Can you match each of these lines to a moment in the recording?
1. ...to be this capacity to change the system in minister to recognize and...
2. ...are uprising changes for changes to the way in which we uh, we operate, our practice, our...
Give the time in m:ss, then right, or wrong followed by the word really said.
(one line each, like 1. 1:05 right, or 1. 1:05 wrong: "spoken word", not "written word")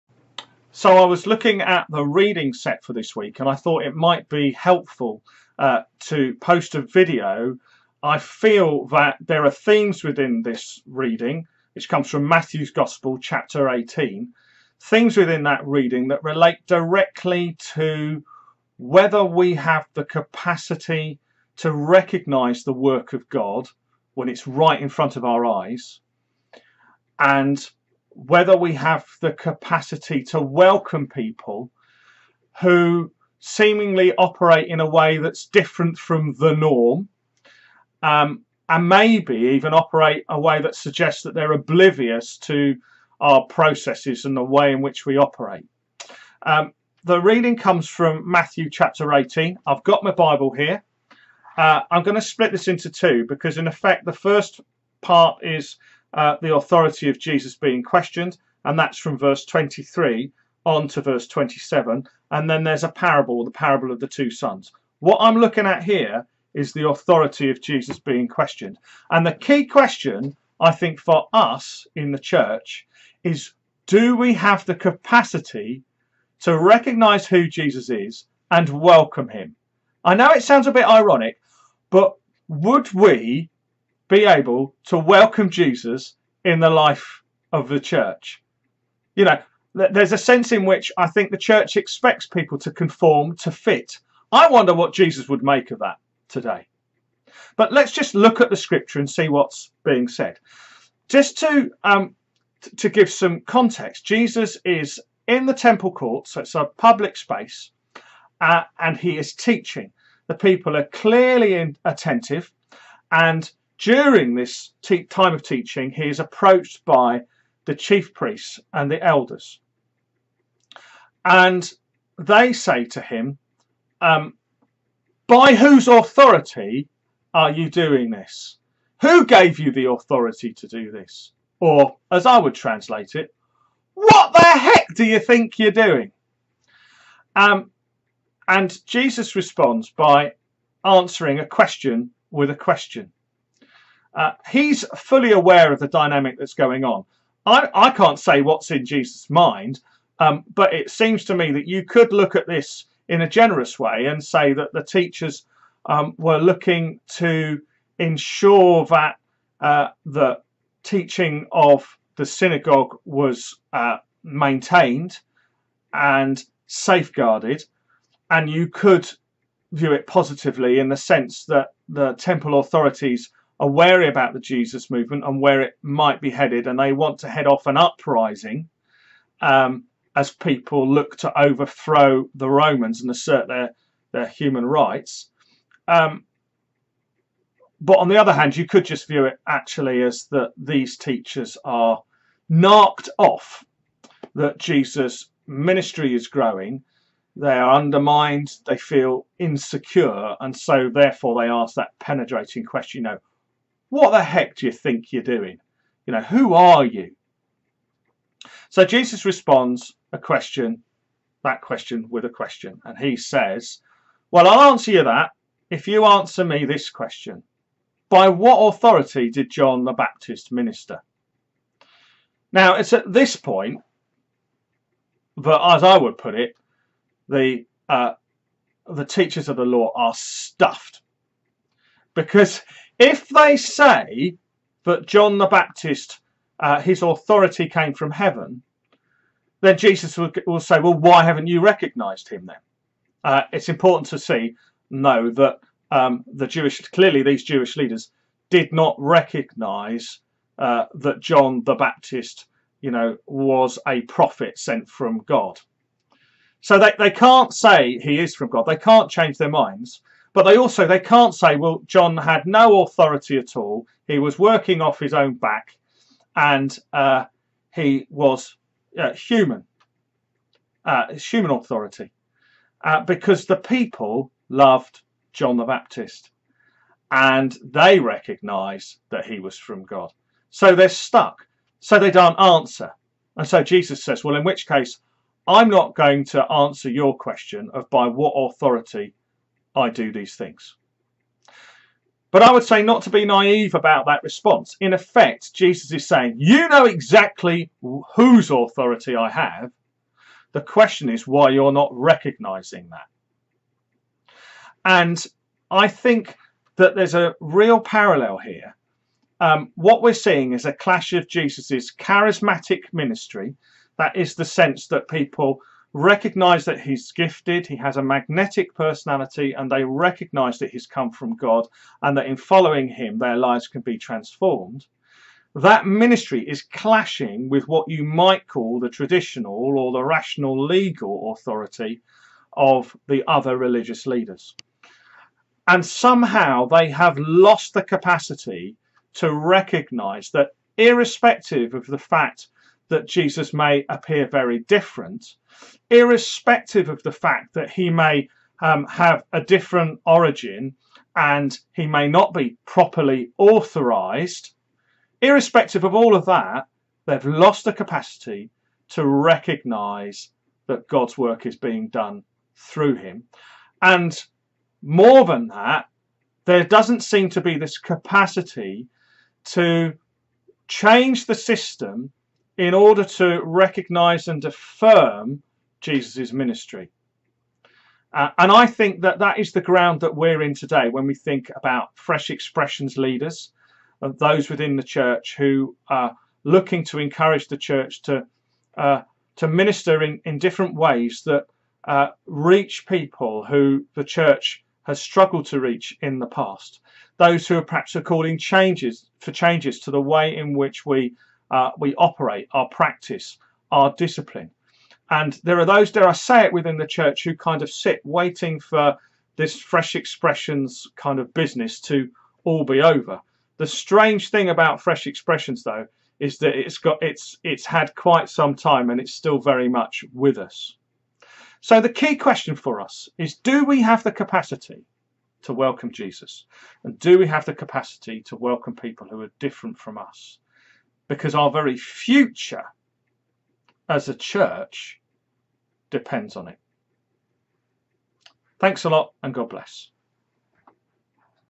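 1. 6:07 wrong: "order", not "minister"
2. 6:37 wrong: "calling", not "uprising".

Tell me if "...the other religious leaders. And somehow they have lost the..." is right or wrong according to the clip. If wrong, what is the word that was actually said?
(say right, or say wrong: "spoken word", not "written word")
right.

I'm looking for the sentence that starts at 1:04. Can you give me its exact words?
What I'm looking at here is the authority of Jesus being questioned.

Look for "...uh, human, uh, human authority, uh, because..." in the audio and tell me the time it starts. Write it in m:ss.
4:28.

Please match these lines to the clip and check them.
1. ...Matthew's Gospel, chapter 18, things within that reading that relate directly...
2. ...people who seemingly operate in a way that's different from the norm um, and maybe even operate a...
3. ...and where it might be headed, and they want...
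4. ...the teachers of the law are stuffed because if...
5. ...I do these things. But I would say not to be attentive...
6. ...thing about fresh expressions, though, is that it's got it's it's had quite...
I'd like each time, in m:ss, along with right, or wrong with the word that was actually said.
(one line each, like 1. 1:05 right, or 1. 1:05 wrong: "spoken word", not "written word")
1. 0:12 right
2. 0:31 right
3. 2:55 right
4. 3:48 right
5. 4:49 wrong: "naive", not "attentive"
6. 6:54 right.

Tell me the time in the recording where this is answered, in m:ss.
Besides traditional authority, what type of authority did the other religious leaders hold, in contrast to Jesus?
5:30.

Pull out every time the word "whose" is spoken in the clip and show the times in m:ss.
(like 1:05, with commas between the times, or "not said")
2:05, 4:58.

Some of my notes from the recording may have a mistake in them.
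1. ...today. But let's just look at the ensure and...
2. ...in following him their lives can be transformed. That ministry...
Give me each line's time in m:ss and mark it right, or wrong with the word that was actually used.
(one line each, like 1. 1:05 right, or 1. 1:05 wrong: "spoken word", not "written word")
1. 1:36 wrong: "scripture", not "ensure"
2. 5:22 right.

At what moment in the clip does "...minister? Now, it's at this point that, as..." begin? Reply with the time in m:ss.
3:40.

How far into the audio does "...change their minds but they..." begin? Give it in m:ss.
4:19.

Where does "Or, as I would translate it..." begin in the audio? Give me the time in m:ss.
2:11.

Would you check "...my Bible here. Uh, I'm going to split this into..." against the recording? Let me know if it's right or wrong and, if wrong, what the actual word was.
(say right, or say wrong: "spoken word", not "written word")
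right.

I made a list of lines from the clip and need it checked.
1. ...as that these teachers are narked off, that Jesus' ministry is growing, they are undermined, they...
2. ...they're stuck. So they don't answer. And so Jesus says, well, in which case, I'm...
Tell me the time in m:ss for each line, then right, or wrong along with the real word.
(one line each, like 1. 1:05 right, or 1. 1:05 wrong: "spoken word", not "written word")
1. 3:10 right
2. 4:40 right.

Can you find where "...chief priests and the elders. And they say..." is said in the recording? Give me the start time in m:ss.
1:57.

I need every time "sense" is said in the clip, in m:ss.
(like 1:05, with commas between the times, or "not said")
1:30, 2:50, 5:14.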